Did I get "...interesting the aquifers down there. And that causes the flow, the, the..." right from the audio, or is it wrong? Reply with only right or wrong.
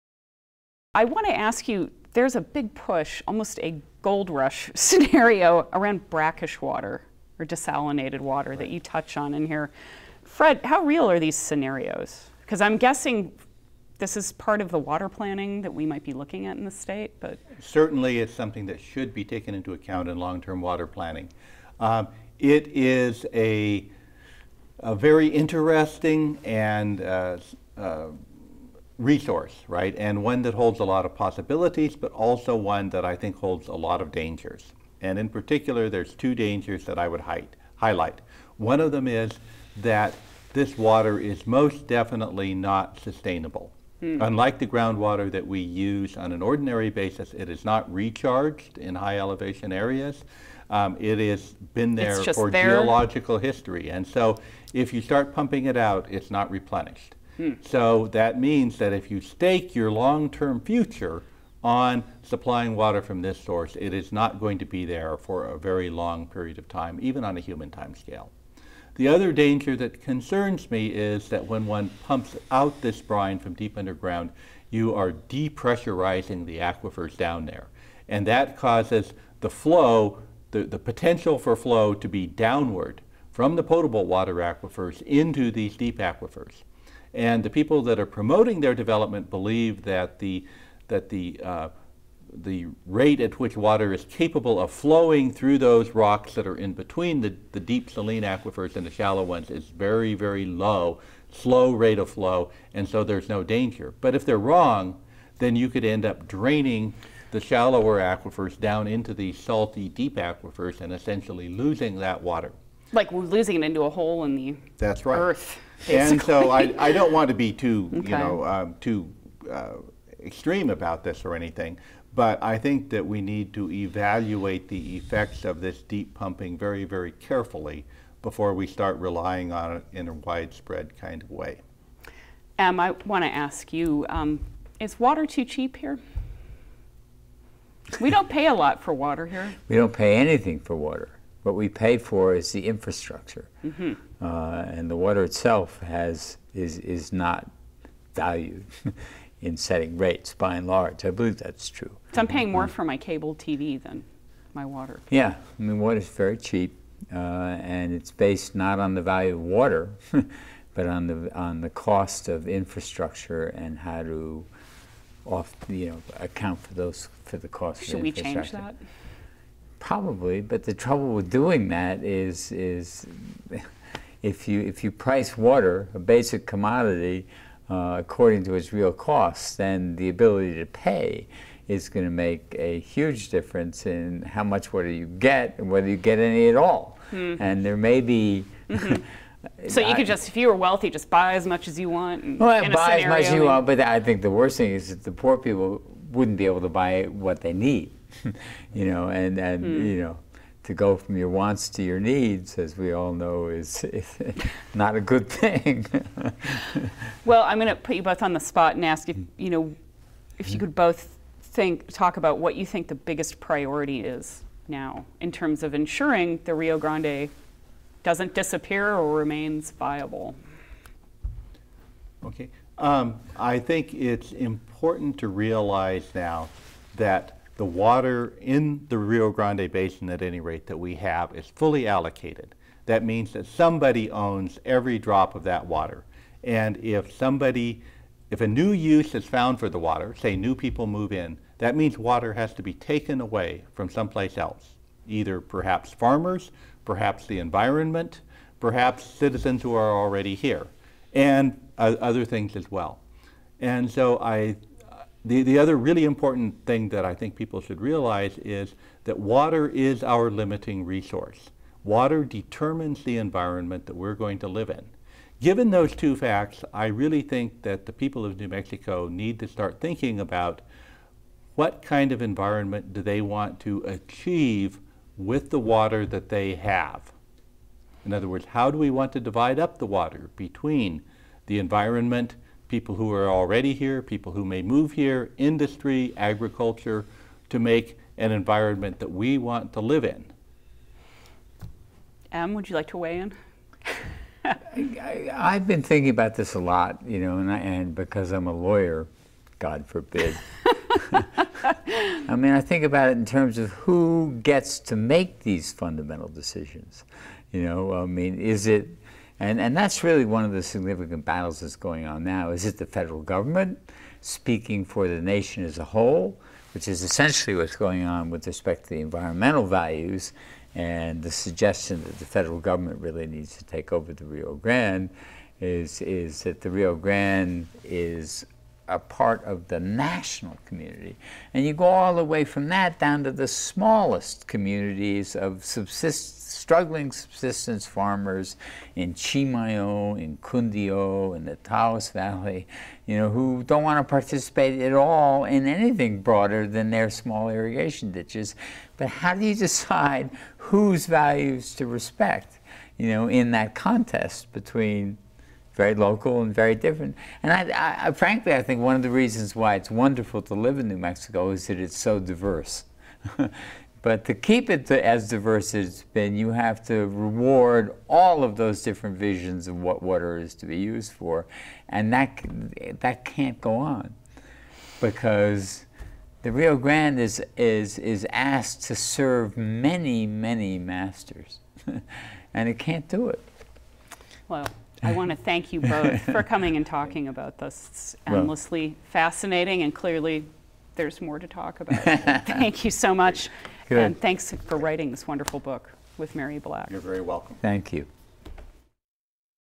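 wrong.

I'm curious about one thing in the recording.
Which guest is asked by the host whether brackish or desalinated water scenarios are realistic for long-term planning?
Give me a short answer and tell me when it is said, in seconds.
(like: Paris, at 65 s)
Fred, at 10 s.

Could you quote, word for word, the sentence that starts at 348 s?
But how do you decide whose values to respect, you know, in that contest between very local and very different.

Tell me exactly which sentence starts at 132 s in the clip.
um, I want to ask you, um, is water too cheap here?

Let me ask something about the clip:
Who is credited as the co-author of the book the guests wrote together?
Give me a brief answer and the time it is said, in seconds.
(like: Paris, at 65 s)
Mary Black, at 396 s.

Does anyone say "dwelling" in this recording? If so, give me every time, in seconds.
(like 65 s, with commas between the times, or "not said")
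not said.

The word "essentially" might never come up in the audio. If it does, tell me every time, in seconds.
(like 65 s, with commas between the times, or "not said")
110 s, 317 s.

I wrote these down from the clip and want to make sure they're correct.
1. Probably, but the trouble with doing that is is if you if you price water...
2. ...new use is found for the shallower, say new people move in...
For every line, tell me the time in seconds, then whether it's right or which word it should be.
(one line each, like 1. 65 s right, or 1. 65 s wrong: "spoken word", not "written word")
1. 169 s right
2. 238 s wrong: "water", not "shallower".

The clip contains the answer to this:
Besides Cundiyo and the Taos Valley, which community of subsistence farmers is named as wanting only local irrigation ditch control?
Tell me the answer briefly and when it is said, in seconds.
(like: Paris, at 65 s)
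Chimayo, at 339 s.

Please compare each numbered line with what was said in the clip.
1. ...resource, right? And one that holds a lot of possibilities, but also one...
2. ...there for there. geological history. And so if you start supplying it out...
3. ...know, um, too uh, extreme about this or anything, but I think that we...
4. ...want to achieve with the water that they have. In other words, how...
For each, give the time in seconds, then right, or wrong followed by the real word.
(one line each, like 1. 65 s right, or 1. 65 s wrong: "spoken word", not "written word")
1. 29 s right
2. 51 s wrong: "pumping", not "supplying"
3. 118 s right
4. 273 s right.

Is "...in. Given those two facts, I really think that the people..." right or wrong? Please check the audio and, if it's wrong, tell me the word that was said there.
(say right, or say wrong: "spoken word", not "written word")
right.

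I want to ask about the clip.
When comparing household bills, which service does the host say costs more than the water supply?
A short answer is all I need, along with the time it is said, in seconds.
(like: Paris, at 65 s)
cable TV, at 152 s.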